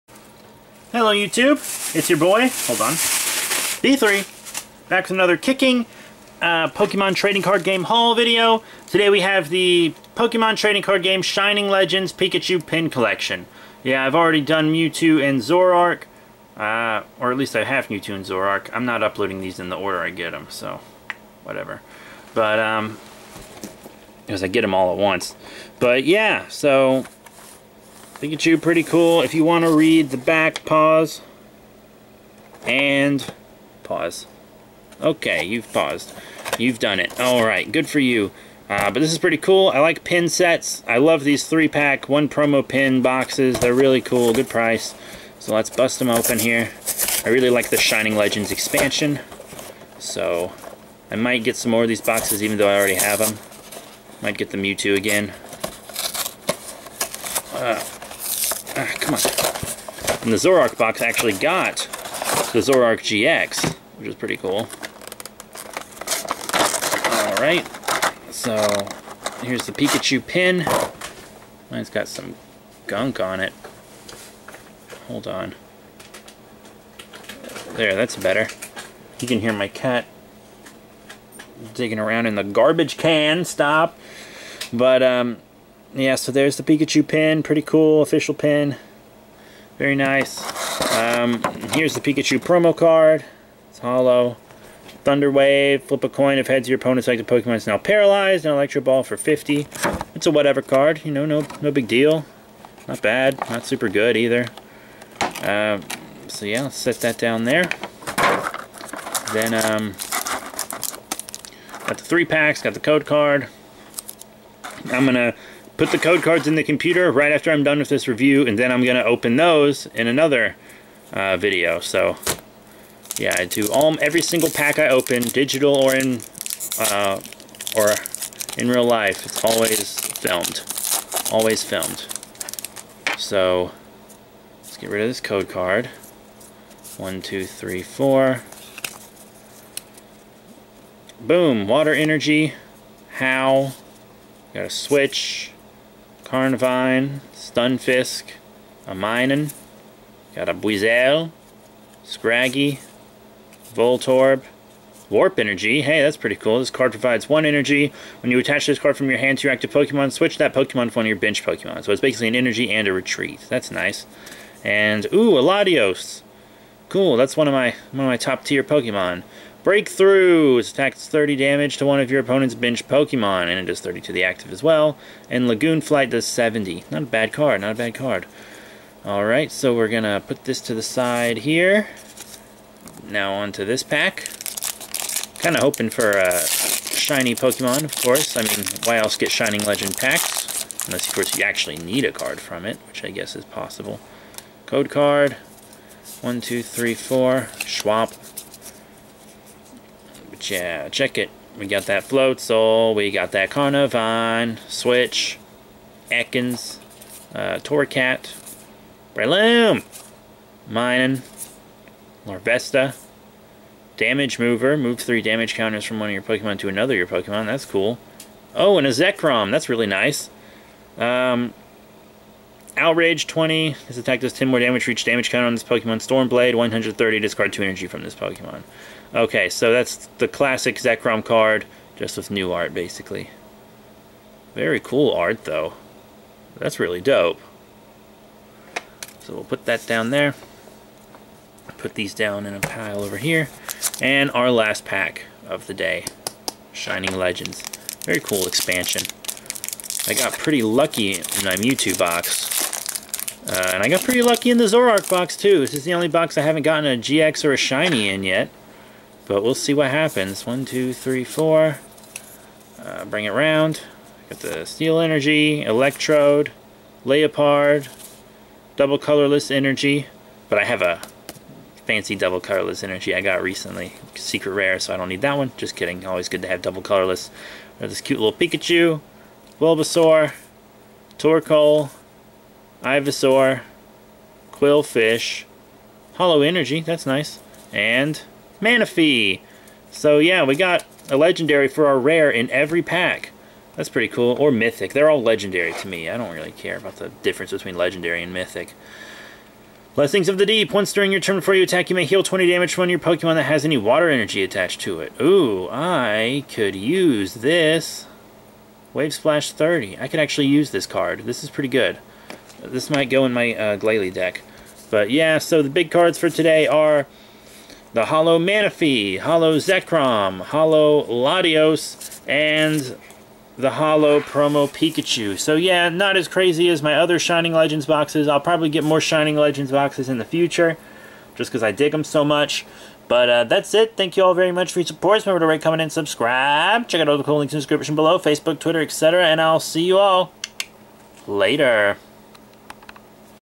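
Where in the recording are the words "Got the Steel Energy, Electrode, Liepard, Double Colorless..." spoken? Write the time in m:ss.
4:24.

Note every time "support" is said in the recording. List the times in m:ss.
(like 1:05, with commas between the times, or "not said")
5:34.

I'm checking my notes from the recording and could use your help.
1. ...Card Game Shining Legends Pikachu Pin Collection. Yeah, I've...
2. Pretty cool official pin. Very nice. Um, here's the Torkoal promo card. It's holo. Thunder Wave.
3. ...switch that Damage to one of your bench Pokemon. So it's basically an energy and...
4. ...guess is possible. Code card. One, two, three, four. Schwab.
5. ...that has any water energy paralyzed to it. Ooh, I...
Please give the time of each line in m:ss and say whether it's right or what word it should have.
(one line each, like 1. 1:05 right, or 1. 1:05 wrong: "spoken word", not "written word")
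1. 0:10 right
2. 1:27 wrong: "Pikachu", not "Torkoal"
3. 2:40 wrong: "Pokemon", not "Damage"
4. 3:13 right
5. 5:03 wrong: "attached", not "paralyzed".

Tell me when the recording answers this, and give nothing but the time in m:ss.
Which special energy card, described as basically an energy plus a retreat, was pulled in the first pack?
2:35.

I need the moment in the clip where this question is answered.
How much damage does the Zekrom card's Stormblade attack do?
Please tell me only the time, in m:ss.
3:46.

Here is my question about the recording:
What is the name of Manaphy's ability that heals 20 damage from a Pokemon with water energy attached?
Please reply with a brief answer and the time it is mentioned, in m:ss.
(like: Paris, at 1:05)
Blessings of the Deep, at 4:59.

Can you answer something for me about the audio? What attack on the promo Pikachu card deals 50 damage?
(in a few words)
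Electro Ball.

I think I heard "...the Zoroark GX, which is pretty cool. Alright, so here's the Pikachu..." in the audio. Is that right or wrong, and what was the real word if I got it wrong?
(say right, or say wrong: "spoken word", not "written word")
right.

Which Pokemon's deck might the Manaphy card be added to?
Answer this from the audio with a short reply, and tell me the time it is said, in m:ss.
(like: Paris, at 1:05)
Glalie, at 5:13.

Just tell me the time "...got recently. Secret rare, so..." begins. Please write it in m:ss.
4:33.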